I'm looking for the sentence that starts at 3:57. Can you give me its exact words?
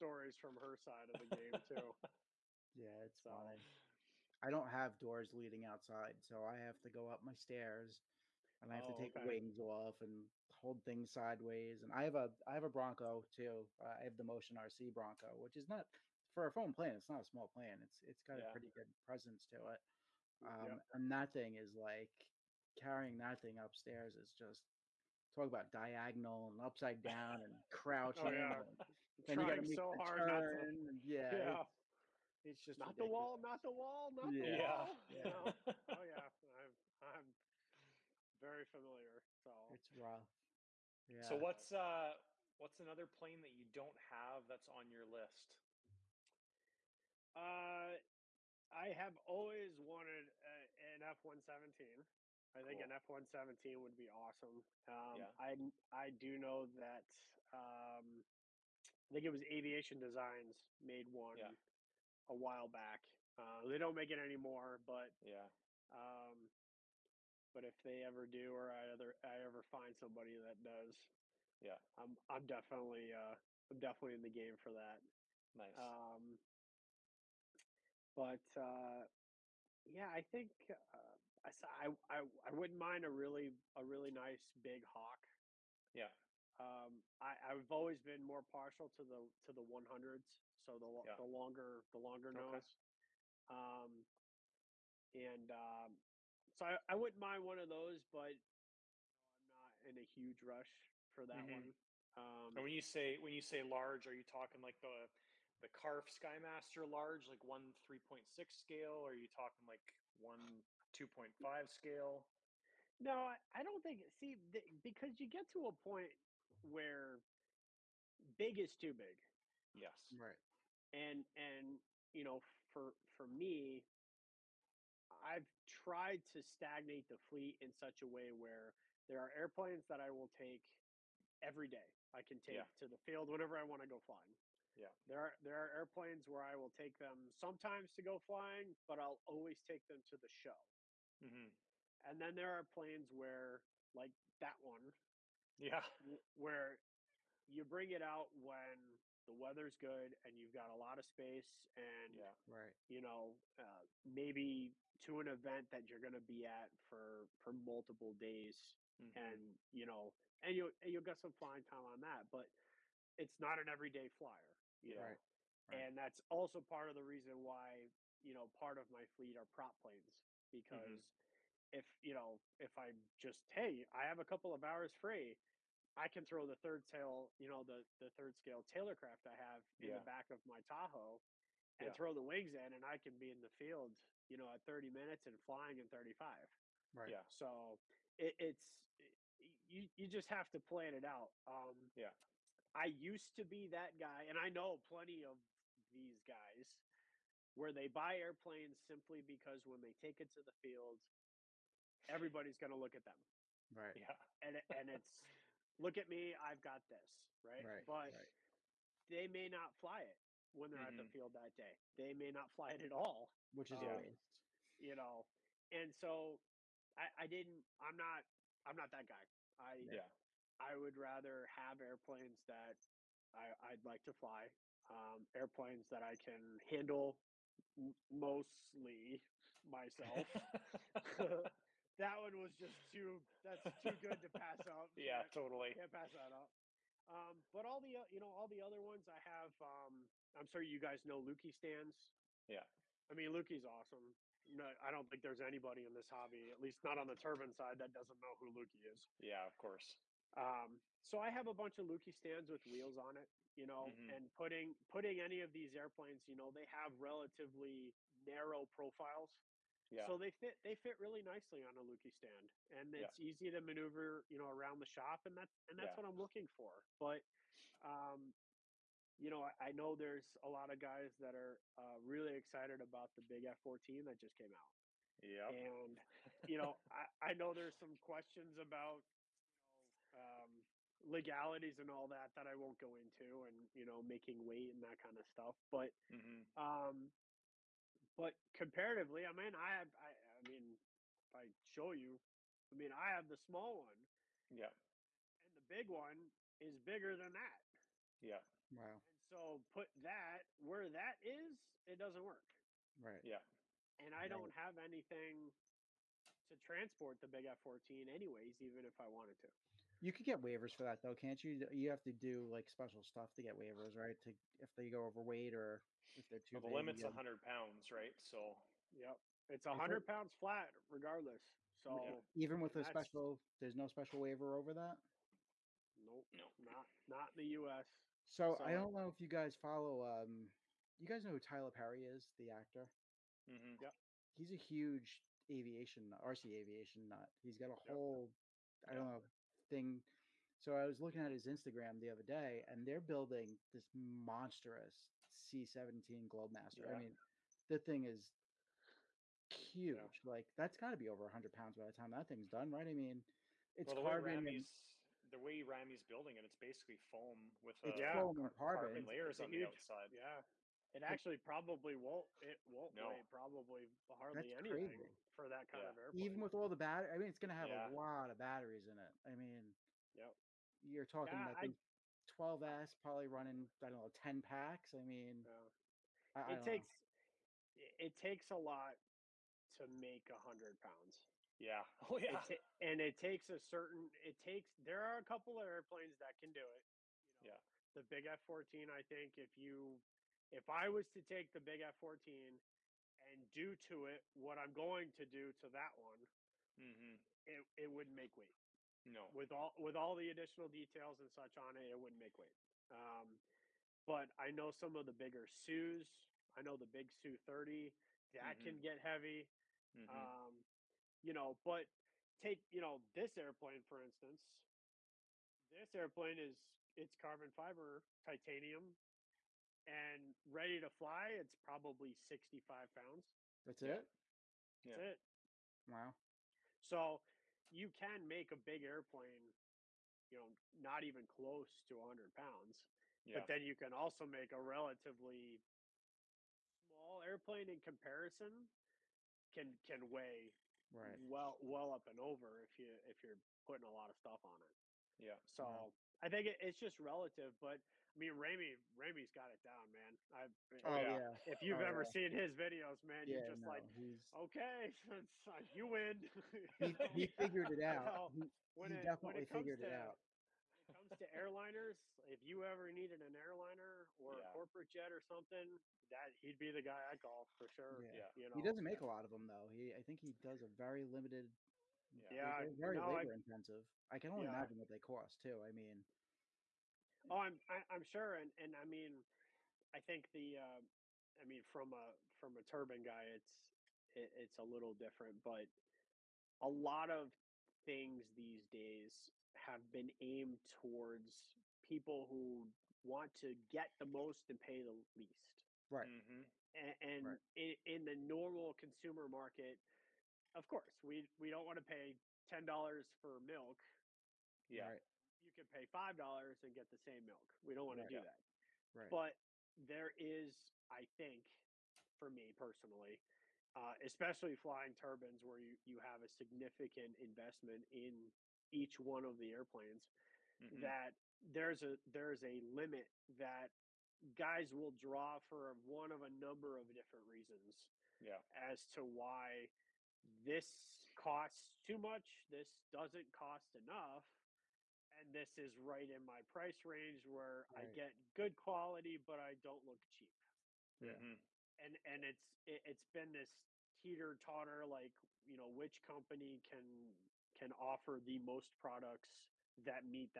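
Um, but all the you know all the other ones I have.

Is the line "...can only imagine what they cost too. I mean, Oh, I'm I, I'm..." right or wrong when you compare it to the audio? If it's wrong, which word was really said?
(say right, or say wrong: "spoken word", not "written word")
right.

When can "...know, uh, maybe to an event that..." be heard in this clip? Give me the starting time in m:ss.
2:33.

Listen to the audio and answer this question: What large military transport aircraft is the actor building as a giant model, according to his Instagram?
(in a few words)
C-17 Globemaster.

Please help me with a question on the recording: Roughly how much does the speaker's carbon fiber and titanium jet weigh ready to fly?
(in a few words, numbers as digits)
65 pounds.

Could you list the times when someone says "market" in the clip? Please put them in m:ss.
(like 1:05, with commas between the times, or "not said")
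8:19.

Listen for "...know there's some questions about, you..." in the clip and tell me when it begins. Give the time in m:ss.
4:37.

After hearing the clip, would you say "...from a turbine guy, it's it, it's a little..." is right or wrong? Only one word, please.
right.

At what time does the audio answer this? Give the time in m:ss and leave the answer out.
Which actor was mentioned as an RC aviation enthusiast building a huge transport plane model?
5:31.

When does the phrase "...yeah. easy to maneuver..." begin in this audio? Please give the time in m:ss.
4:23.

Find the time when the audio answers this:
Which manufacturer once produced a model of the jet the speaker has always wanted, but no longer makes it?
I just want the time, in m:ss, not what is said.
0:59.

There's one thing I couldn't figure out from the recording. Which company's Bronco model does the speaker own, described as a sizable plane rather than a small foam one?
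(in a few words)
Motion RC.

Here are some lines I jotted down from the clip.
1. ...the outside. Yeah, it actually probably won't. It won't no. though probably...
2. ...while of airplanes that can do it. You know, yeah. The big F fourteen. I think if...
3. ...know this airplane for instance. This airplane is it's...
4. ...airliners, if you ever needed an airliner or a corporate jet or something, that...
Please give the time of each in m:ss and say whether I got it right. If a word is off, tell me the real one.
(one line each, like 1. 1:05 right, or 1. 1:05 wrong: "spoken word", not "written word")
1. 5:59 wrong: "weigh", not "though"
2. 6:25 wrong: "couple", not "while"
3. 6:52 right
4. 7:41 right.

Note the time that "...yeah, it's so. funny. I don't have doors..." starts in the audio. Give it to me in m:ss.
0:02.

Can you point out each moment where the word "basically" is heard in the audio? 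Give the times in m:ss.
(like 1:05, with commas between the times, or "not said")
5:56.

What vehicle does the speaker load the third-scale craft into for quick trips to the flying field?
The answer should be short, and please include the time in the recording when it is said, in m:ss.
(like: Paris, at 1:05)
Tahoe, at 3:00.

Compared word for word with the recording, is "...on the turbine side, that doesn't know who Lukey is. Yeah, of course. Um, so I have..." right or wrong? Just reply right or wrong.
right.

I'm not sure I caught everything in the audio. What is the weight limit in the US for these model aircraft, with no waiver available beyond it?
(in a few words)
100 pounds.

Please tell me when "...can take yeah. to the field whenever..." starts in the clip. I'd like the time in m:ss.
2:12.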